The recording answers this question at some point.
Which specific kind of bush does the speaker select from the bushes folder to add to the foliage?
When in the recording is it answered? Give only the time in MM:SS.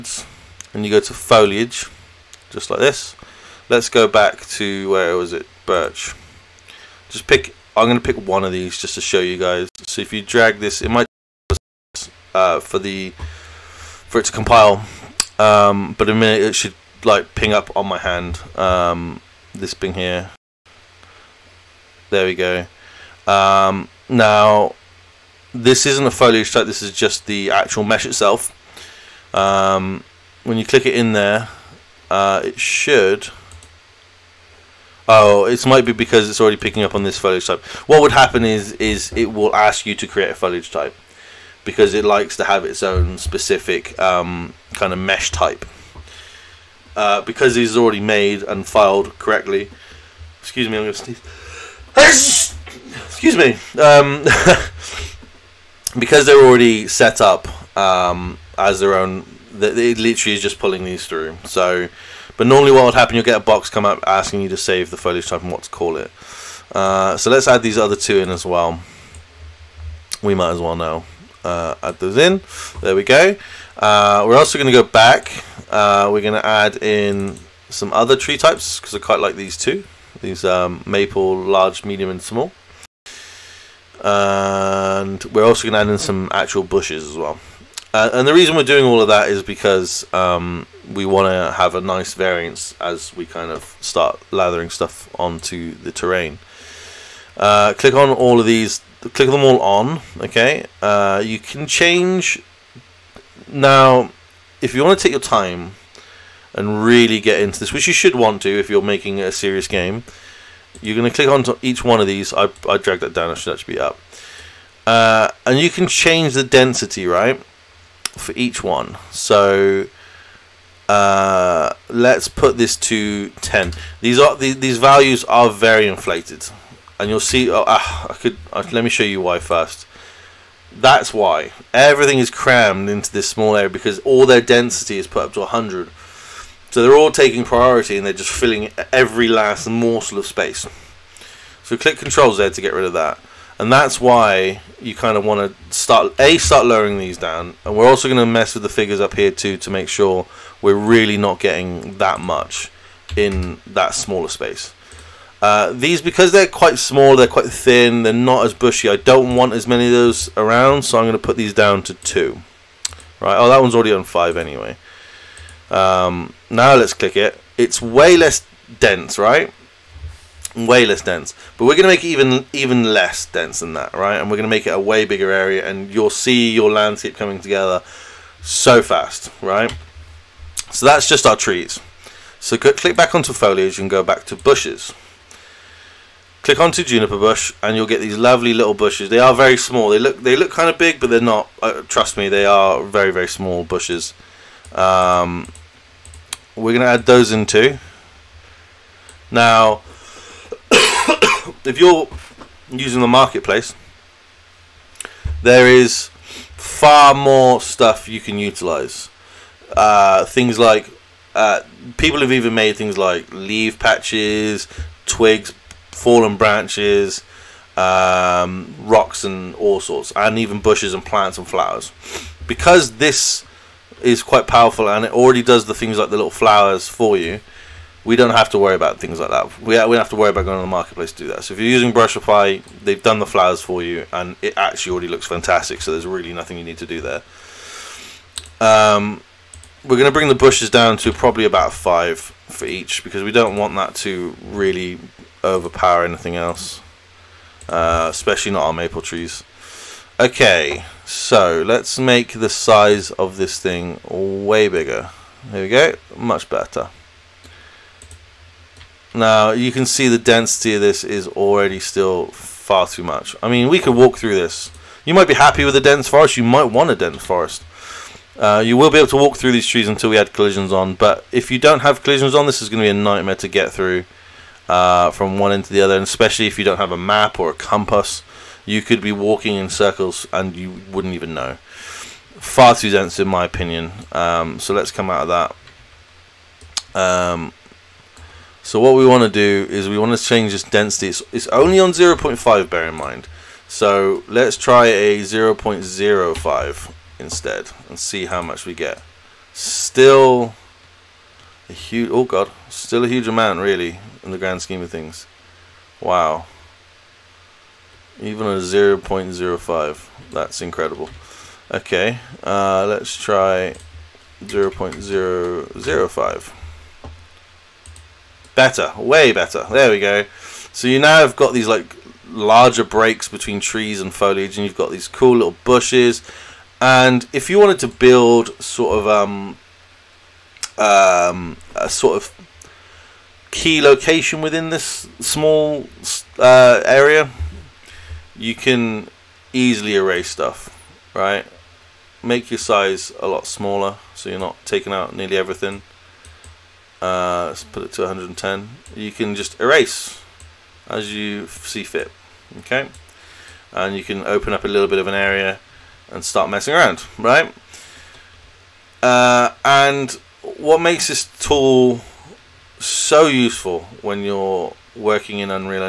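03:06.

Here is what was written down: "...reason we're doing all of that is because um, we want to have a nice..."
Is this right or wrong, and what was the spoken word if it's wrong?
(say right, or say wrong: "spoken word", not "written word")
right.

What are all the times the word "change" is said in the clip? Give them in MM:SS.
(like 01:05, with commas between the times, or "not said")
01:41, 01:55, 04:50.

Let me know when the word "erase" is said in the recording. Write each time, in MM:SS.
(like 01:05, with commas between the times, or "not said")
05:39, 05:49.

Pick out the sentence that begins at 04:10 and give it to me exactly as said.
Okay, so let's make the size of this thing way bigger.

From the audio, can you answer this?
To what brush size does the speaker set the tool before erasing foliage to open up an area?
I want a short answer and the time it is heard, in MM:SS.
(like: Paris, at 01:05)
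110, at 05:48.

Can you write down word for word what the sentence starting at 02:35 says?
Uh, these, because they're quite small, they're quite thin, they're not as bushy.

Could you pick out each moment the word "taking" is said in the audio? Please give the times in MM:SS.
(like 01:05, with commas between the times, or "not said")
02:17, 05:44.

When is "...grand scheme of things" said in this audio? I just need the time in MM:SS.
05:04.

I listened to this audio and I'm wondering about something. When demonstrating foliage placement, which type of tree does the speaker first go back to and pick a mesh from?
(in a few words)
Birch.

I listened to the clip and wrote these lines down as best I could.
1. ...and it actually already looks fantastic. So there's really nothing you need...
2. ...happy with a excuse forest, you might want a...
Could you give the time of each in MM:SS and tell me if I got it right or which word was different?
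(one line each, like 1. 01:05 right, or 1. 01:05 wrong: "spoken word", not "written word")
1. 03:54 right
2. 04:25 wrong: "dense", not "excuse".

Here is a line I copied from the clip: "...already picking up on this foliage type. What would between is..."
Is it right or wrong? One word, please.
wrong.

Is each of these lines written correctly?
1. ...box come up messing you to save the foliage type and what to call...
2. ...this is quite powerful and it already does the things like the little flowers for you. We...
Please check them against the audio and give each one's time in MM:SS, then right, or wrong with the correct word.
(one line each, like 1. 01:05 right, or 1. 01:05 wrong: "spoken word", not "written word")
1. 01:03 wrong: "asking", not "messing"
2. 03:42 right.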